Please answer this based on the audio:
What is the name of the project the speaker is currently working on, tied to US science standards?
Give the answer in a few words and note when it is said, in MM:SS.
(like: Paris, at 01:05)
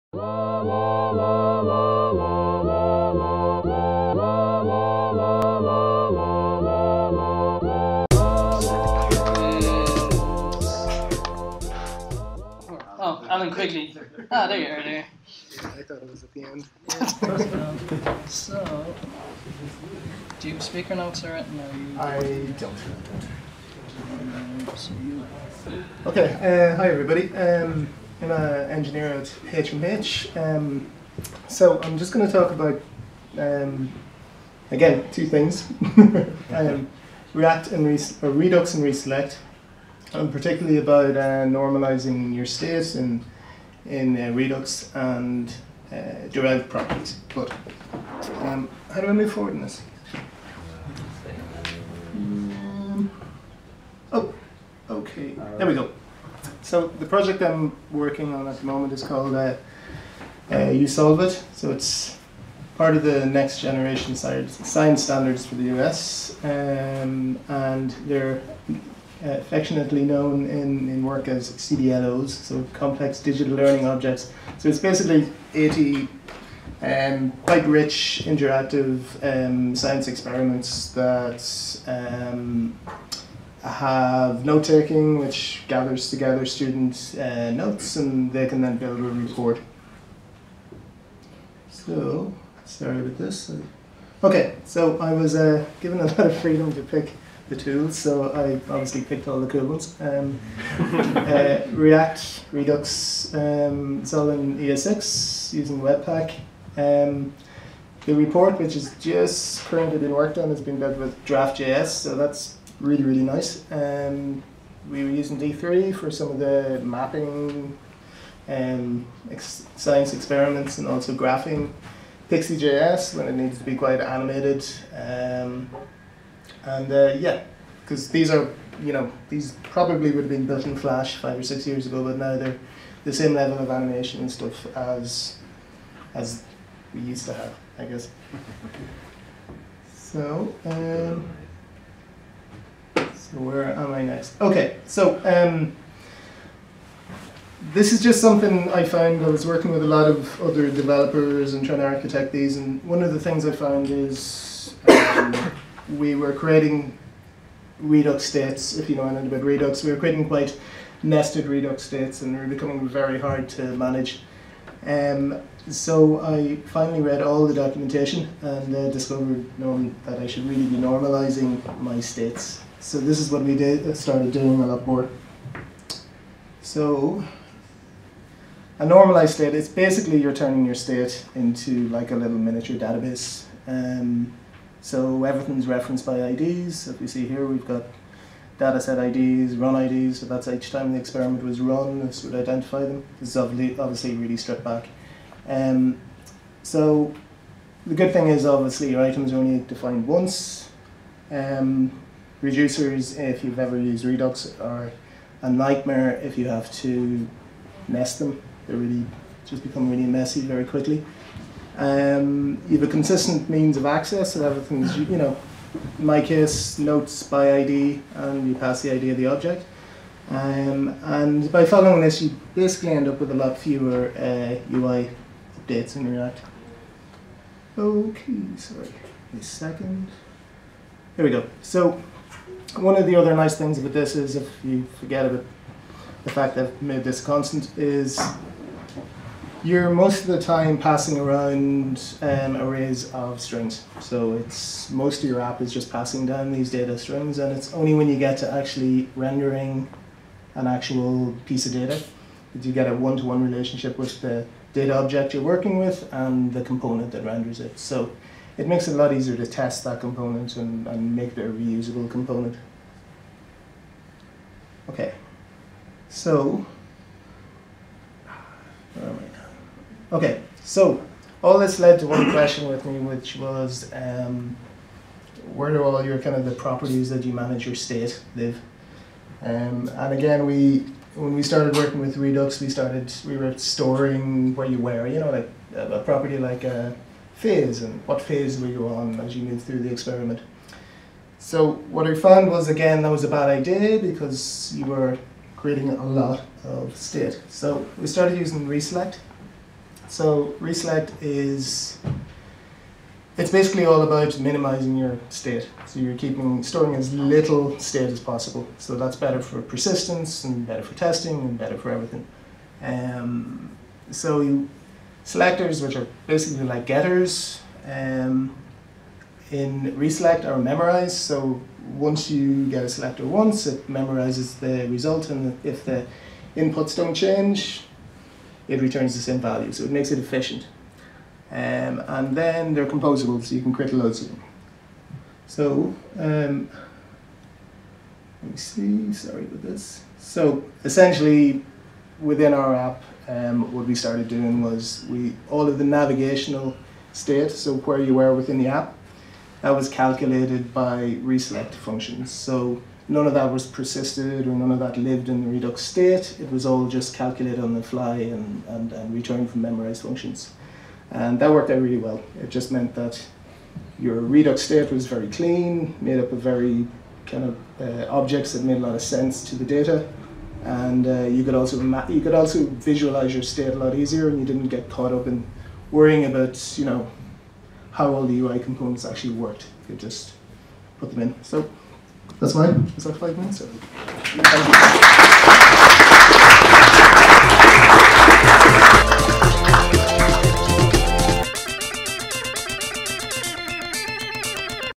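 You Solve It, at 01:00.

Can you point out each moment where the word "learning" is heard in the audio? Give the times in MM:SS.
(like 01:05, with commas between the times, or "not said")
01:13.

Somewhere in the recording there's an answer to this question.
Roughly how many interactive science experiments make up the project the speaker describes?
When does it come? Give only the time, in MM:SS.
01:15.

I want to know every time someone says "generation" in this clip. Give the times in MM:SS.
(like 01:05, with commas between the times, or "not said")
01:03.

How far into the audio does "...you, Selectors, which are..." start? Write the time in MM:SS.
05:14.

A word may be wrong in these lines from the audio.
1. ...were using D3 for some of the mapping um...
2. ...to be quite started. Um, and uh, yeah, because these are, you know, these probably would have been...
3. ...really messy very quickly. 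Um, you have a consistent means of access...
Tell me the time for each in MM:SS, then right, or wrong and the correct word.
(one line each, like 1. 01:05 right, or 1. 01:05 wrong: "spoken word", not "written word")
1. 01:55 right
2. 02:03 wrong: "animated", not "started"
3. 03:29 right.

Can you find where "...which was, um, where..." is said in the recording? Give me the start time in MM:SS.
04:32.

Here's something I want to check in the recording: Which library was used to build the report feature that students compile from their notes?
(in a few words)
Draft.js.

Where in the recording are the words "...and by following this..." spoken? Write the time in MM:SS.
03:41.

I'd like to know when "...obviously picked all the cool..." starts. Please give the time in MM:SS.
01:38.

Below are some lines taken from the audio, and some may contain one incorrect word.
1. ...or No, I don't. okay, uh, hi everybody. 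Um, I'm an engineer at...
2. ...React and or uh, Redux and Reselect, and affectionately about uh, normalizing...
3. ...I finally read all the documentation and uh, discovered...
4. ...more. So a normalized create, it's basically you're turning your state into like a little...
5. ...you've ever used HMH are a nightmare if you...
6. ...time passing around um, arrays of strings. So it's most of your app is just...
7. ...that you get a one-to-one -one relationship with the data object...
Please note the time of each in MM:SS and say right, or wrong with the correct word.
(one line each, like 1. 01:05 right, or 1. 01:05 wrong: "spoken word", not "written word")
1. 00:21 right
2. 00:37 wrong: "particularly", not "affectionately"
3. 02:46 right
4. 02:54 wrong: "state", not "create"
5. 03:23 wrong: "Redux", not "HMH"
6. 04:00 right
7. 04:12 right.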